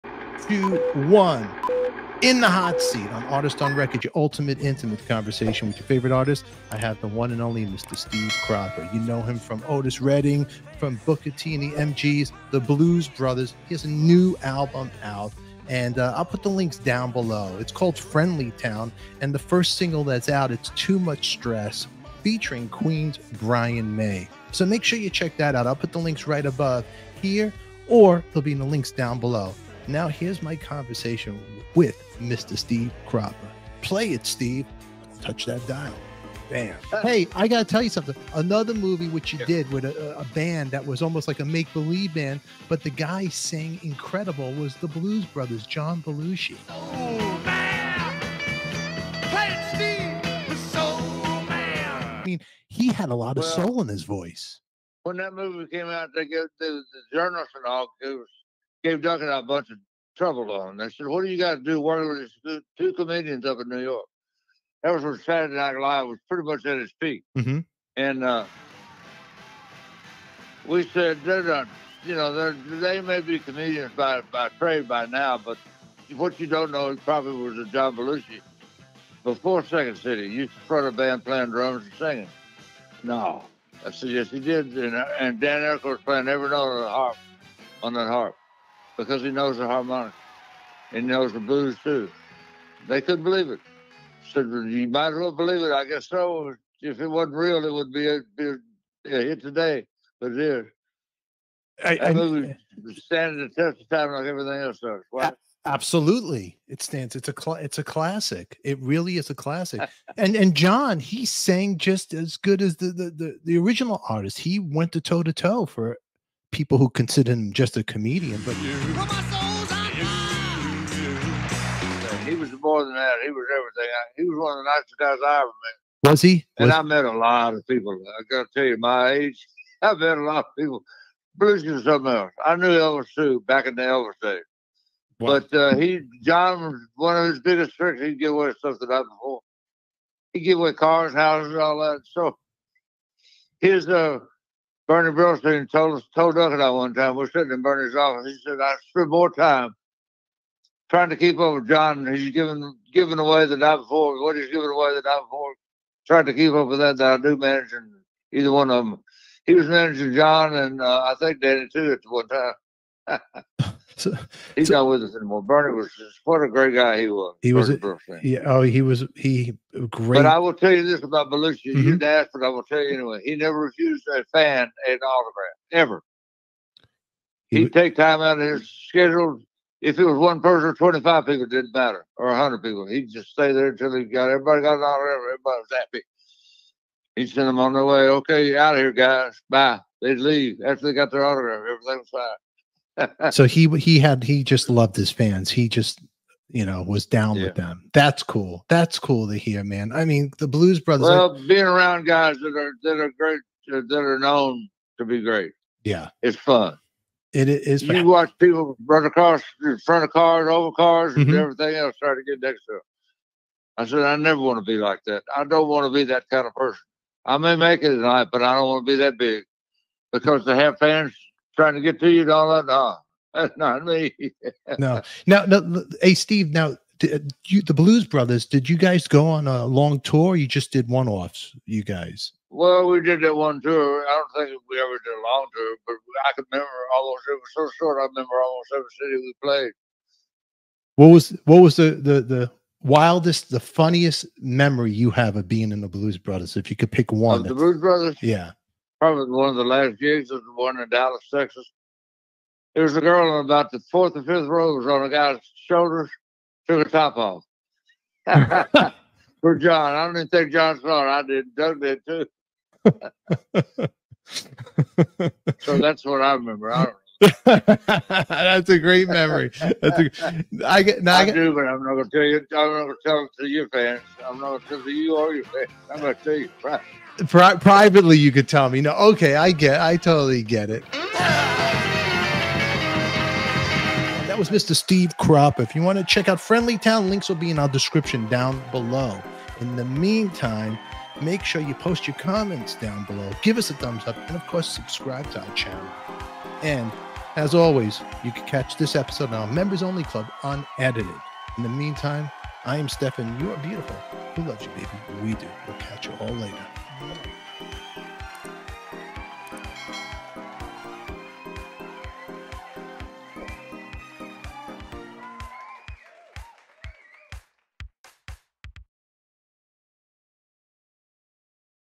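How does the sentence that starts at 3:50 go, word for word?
you just did one offs, you guys?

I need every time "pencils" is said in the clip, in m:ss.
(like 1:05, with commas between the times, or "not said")
not said.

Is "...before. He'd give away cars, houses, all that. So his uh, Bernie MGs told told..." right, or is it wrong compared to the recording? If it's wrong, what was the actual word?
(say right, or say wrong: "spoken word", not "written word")
wrong: "Brillstein", not "MGs".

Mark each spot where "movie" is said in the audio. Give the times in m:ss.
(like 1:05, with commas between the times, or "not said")
0:38, 0:55, 1:42.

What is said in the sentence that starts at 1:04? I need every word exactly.
That was when Saturday Night Live was pretty much at its peak.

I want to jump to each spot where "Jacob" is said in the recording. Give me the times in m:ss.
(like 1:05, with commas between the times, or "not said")
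not said.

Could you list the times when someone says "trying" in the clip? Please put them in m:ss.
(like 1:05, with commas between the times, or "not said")
2:30, 2:36, 3:41.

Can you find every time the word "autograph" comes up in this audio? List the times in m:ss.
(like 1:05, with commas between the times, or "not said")
2:54, 3:04, 3:11.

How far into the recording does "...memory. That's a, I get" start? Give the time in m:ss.
4:29.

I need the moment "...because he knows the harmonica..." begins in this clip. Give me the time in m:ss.
1:29.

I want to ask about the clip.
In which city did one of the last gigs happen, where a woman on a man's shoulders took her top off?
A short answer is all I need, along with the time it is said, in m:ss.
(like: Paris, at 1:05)
Dallas, Texas, at 4:10.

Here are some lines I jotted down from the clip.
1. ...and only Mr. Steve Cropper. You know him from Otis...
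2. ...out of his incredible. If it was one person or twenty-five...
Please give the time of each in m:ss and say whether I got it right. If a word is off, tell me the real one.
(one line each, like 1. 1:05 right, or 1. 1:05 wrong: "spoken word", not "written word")
1. 0:07 right
2. 2:58 wrong: "schedule", not "incredible".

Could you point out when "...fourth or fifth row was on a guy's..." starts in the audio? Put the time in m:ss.
4:13.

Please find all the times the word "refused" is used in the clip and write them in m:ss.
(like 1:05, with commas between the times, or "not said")
2:53.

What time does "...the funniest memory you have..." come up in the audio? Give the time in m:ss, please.
4:03.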